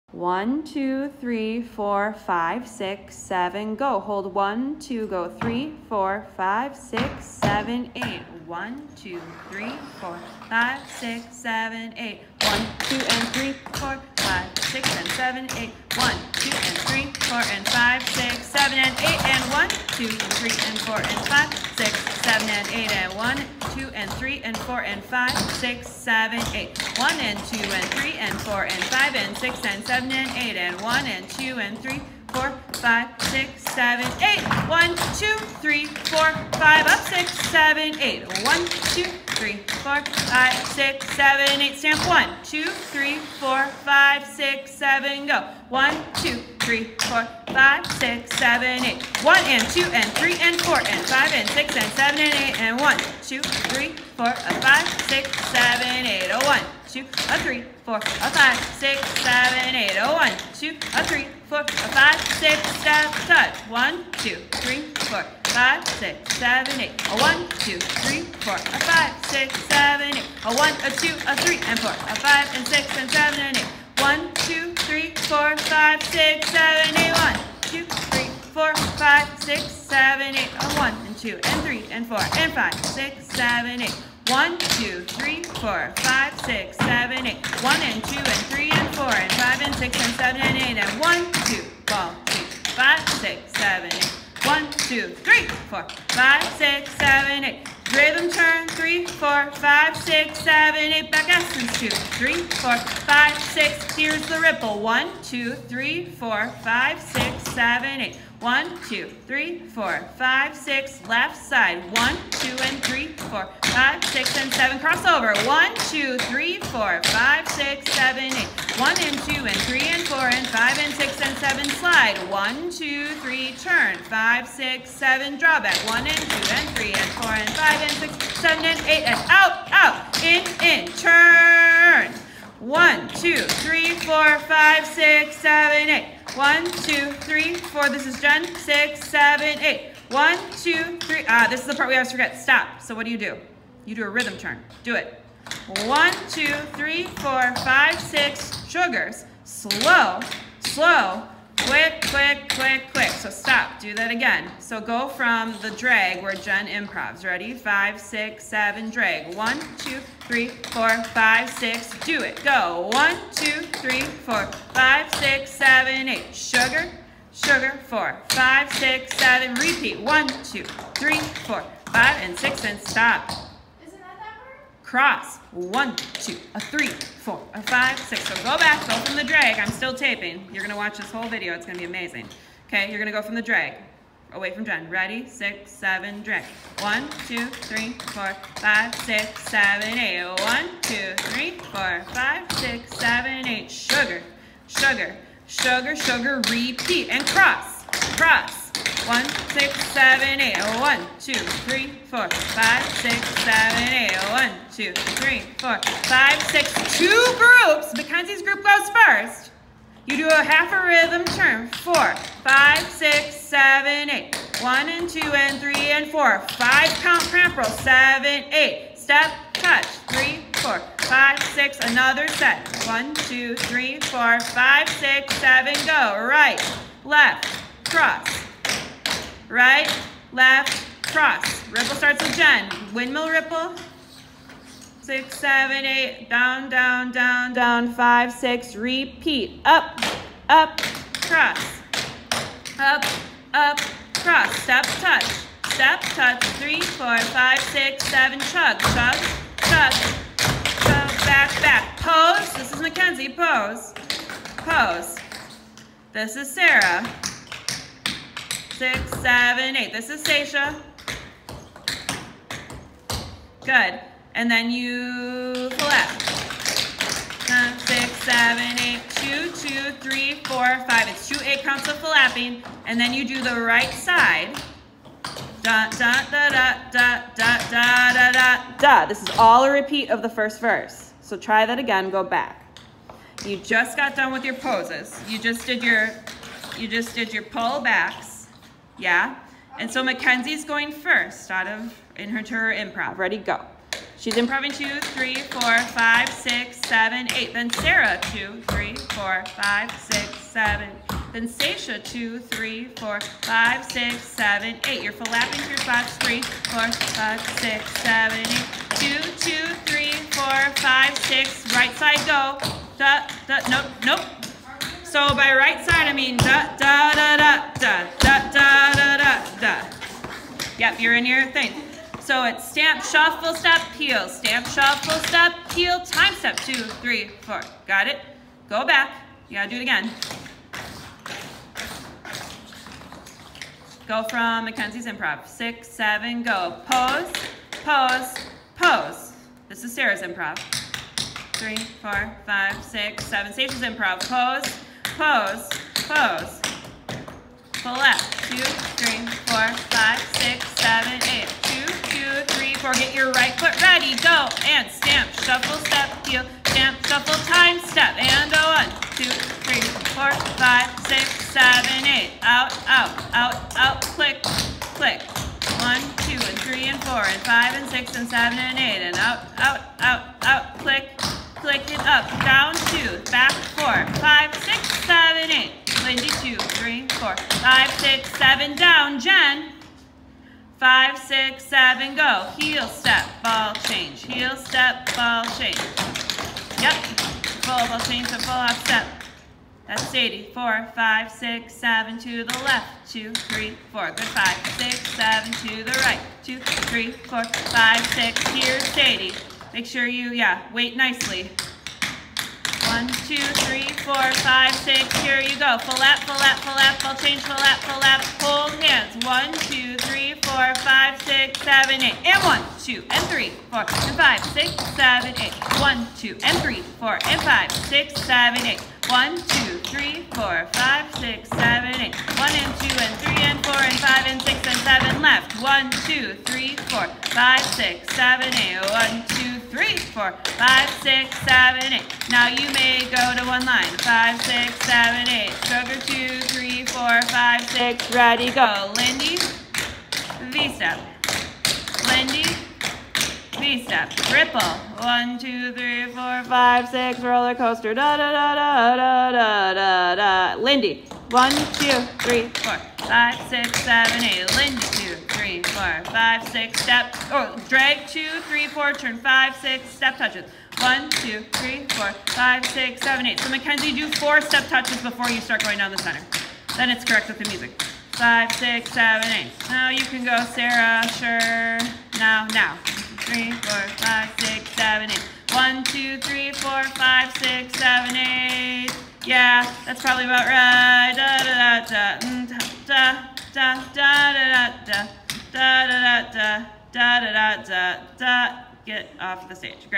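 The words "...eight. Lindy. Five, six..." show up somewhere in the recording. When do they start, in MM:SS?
07:34.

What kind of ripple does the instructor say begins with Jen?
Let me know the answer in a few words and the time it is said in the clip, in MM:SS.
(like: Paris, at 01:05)
Windmill ripple, at 03:52.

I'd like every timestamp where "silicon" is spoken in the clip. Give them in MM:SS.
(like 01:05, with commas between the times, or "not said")
not said.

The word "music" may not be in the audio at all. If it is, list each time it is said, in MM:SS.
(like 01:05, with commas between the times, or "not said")
07:47.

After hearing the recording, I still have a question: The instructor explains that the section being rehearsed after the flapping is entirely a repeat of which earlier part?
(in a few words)
The first verse.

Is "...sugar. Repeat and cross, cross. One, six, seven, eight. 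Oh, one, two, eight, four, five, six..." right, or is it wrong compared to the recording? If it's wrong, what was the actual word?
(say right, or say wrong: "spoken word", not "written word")
wrong: "three", not "eight".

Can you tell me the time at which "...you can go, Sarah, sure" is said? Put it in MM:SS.
07:49.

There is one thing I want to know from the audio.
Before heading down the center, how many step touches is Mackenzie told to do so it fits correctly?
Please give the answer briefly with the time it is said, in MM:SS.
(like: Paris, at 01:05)
4, at 07:44.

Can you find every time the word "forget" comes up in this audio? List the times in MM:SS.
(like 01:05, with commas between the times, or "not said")
02:22.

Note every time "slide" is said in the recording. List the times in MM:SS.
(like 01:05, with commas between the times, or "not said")
02:01.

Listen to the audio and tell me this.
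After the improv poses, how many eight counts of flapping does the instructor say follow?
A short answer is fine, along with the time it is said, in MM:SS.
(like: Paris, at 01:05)
2, at 04:31.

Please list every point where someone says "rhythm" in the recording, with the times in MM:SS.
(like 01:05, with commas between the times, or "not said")
01:37, 02:24, 03:30.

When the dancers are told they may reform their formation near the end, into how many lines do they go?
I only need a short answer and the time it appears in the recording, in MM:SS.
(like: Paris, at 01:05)
One line, at 07:13.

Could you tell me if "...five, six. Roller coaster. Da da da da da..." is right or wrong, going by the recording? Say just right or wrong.
right.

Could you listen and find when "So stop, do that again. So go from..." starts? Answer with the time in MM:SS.
02:33.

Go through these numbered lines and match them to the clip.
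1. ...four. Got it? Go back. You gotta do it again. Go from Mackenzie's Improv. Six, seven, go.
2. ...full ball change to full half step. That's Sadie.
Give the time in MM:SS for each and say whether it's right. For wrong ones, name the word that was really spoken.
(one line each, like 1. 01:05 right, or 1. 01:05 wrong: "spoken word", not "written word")
1. 05:27 right
2. 06:27 right.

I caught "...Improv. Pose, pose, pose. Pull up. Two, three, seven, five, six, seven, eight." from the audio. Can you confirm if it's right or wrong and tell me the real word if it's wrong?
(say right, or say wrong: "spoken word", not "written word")
wrong: "four", not "seven".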